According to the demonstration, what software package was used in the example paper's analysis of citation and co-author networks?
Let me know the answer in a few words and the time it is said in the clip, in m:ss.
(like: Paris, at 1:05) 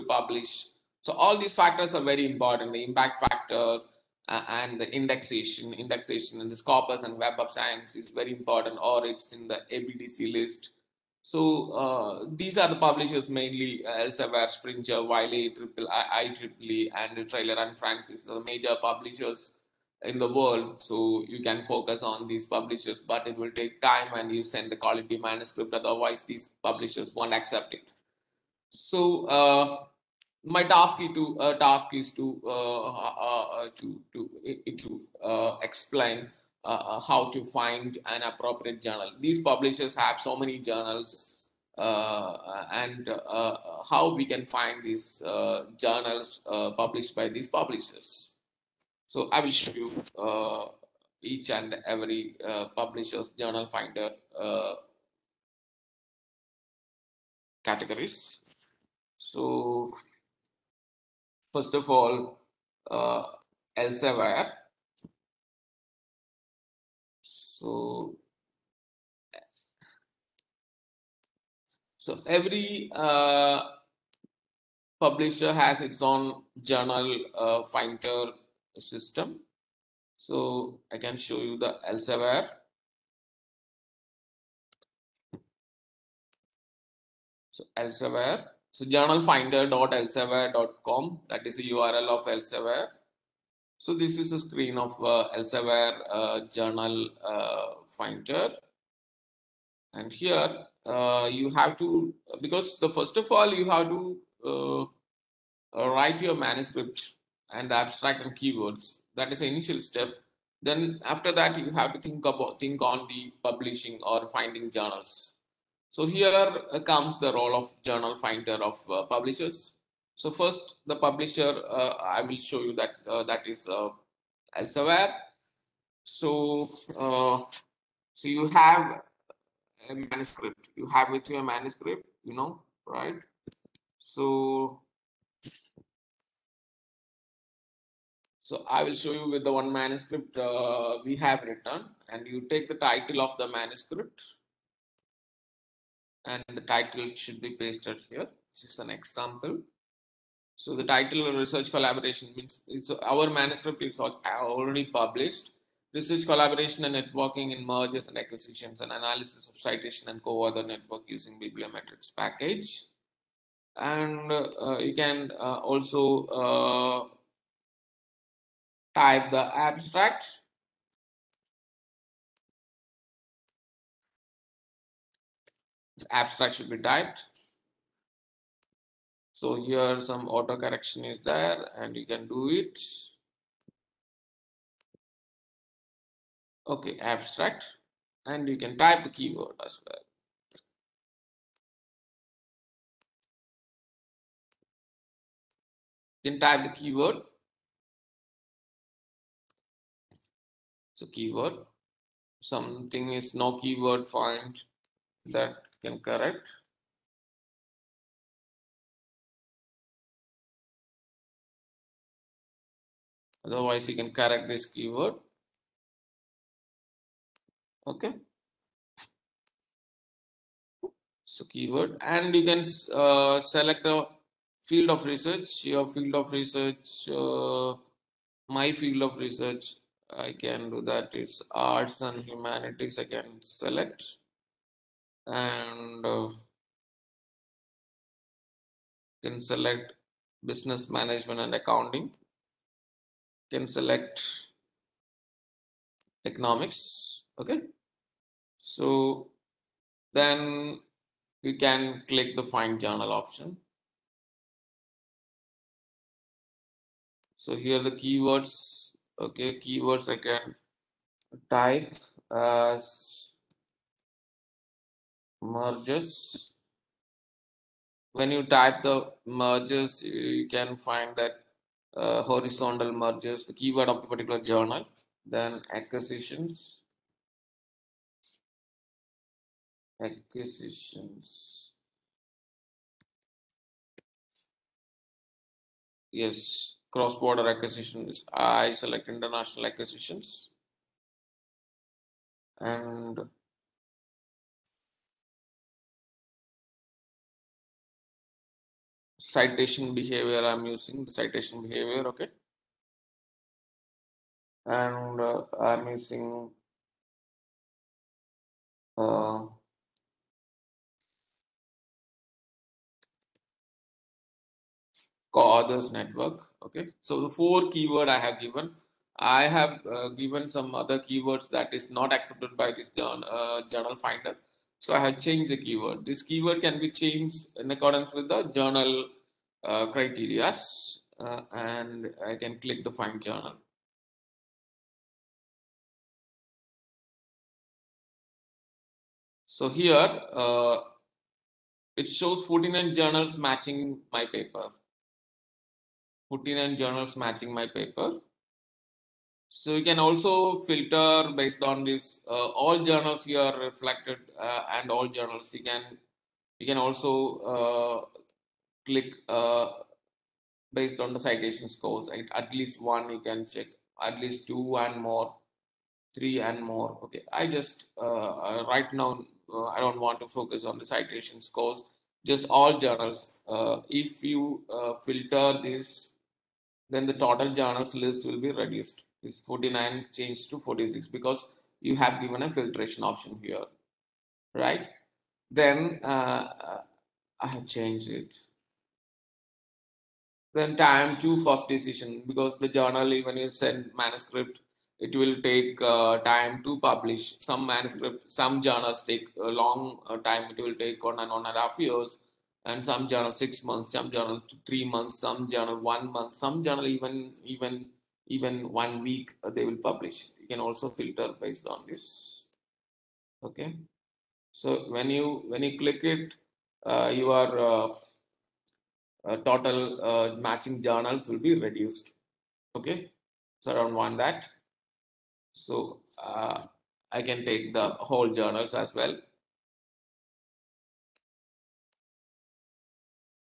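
bibliometrix, at 2:41.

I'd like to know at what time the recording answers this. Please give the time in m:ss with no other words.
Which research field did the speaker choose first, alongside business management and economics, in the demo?
3:51.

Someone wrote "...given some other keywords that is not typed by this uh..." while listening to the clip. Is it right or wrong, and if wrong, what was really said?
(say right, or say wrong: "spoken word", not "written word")
wrong: "accepted", not "typed".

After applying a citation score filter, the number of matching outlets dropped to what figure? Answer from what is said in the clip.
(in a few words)
46.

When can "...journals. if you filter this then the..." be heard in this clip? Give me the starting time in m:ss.
6:12.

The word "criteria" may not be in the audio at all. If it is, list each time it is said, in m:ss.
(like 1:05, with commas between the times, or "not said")
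5:29.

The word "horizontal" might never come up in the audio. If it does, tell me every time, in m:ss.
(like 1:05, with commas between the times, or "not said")
4:32.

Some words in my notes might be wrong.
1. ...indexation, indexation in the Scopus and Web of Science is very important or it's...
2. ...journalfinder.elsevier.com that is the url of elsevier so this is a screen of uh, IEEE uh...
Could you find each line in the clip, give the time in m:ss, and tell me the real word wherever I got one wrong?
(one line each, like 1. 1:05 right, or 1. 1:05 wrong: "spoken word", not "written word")
1. 0:04 right
2. 1:28 wrong: "Elsevier", not "IEEE".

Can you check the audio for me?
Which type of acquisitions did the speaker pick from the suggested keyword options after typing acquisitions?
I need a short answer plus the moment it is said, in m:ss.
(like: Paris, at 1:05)
International acquisitions, at 4:49.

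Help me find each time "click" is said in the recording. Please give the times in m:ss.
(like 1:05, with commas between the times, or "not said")
4:12, 5:32, 5:58, 6:55.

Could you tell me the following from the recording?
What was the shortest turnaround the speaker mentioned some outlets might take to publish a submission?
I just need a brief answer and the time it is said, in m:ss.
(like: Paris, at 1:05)
One week, at 6:48.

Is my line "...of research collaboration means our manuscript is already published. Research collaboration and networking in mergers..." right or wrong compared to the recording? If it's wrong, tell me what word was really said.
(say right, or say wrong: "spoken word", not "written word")
right.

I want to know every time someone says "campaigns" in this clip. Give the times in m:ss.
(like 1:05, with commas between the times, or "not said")
not said.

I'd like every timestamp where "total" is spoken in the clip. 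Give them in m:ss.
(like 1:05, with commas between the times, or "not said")
6:17, 6:59.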